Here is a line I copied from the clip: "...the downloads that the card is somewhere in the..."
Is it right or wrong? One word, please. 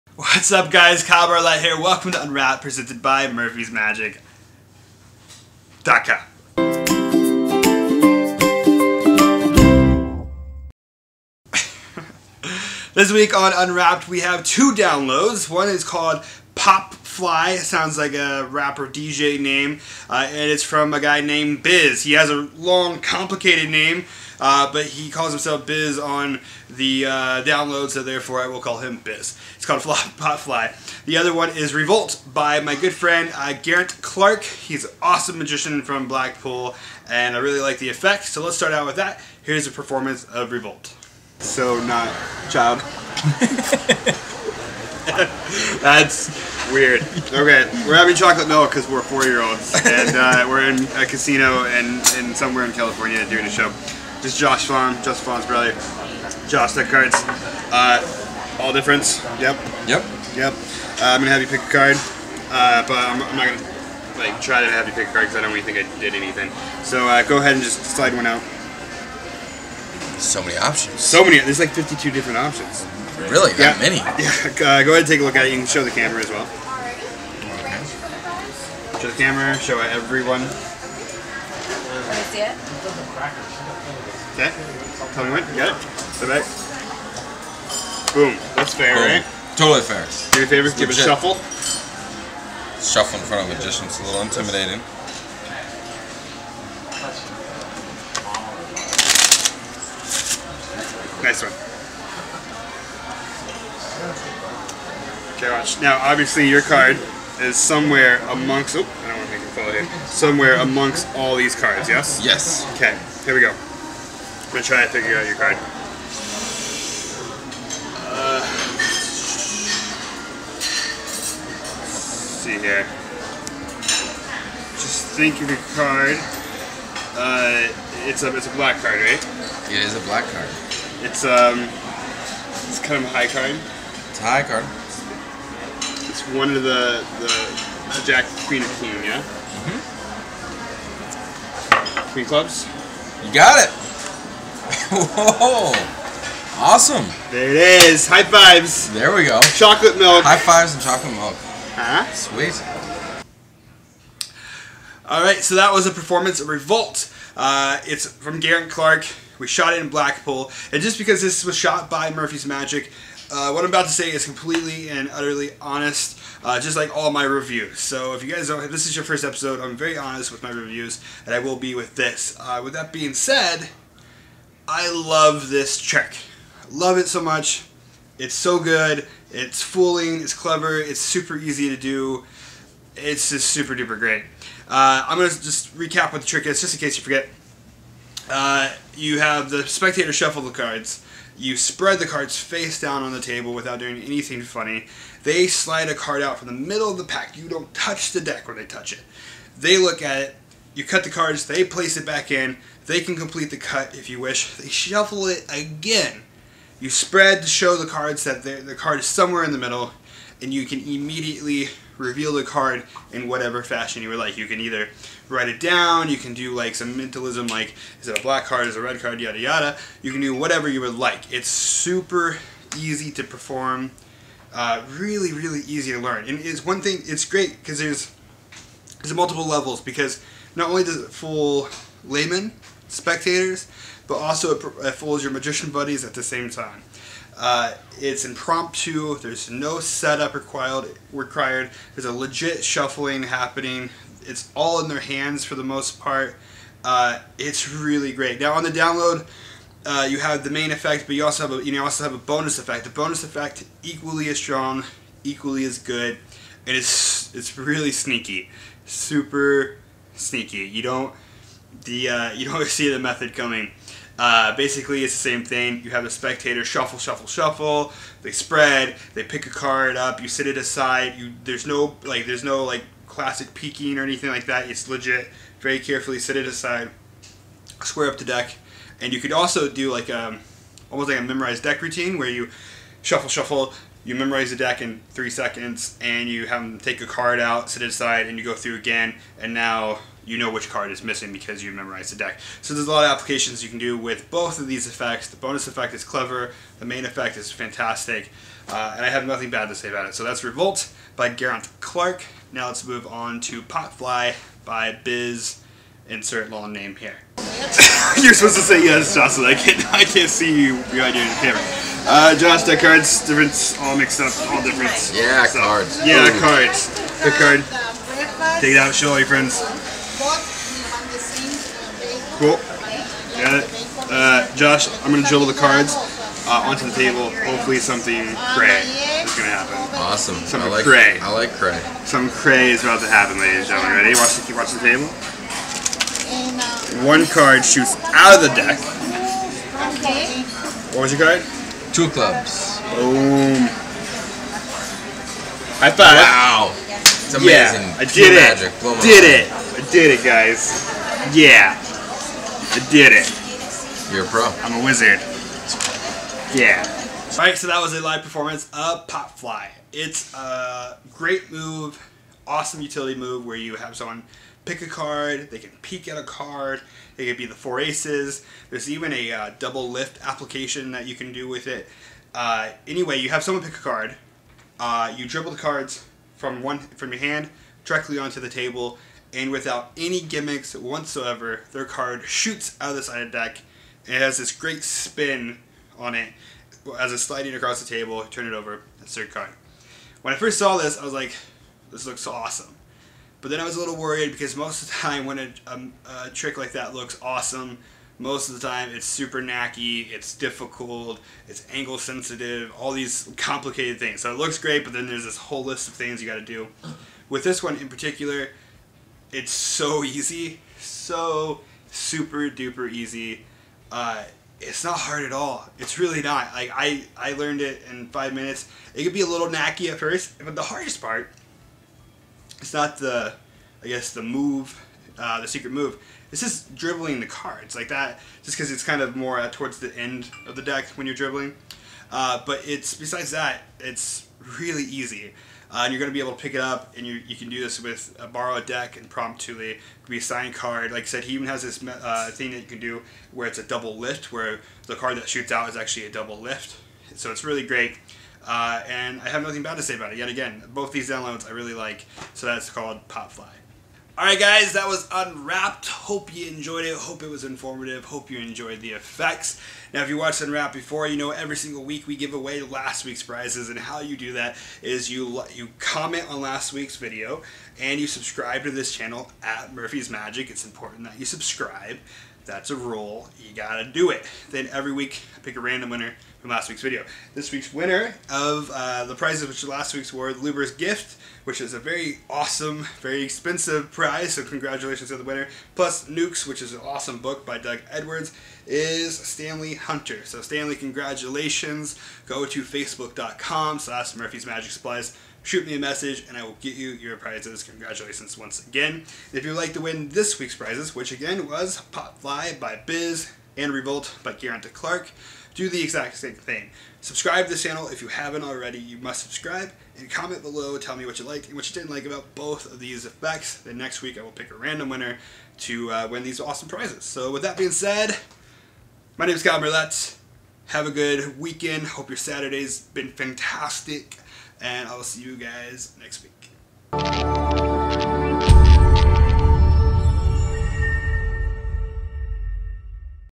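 wrong.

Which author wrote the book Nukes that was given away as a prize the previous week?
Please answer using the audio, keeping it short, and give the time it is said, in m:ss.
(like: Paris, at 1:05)
Doug Edwards, at 8:07.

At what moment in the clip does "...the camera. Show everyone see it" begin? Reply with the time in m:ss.
1:19.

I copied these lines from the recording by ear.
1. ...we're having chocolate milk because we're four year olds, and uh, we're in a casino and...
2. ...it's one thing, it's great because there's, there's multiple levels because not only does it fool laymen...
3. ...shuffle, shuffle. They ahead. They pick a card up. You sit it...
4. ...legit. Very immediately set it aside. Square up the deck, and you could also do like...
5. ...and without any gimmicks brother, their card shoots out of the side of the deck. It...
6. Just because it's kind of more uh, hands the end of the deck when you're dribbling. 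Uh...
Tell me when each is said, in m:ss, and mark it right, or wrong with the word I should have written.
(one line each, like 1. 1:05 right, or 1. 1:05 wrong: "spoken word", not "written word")
1. 0:47 right
2. 3:46 right
3. 4:26 wrong: "spread", not "ahead"
4. 4:34 wrong: "carefully", not "immediately"
5. 6:19 wrong: "whatsoever", not "brother"
6. 7:08 wrong: "towards", not "hands".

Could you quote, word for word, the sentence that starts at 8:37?
So with that being said, my name is Kyle Marlett.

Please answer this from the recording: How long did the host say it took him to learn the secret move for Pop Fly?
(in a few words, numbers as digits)
5 minutes.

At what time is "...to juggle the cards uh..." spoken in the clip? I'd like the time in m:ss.
5:25.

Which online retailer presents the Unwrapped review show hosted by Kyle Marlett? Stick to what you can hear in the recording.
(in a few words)
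Murphy's Magic.com.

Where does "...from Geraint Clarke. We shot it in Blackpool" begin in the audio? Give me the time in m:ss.
2:38.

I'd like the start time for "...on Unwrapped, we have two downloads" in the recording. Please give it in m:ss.
0:13.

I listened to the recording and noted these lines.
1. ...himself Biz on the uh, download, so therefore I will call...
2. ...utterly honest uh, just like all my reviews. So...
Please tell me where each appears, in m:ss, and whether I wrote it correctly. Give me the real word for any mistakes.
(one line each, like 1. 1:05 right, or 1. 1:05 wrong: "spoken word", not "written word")
1. 0:25 right
2. 2:45 right.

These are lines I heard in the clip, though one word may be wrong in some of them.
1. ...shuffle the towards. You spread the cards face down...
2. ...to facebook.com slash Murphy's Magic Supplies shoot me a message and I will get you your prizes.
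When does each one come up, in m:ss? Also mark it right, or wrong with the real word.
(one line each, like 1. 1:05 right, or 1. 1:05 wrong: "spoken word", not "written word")
1. 3:10 wrong: "cards", not "towards"
2. 8:12 right.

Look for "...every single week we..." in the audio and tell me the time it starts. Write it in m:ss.
7:41.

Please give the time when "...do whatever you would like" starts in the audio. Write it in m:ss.
3:40.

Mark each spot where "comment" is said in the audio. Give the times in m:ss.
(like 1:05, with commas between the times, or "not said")
7:45, 8:30.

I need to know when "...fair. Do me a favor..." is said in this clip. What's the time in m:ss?
1:29.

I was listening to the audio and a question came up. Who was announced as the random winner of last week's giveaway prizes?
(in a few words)
Stanley Hunter.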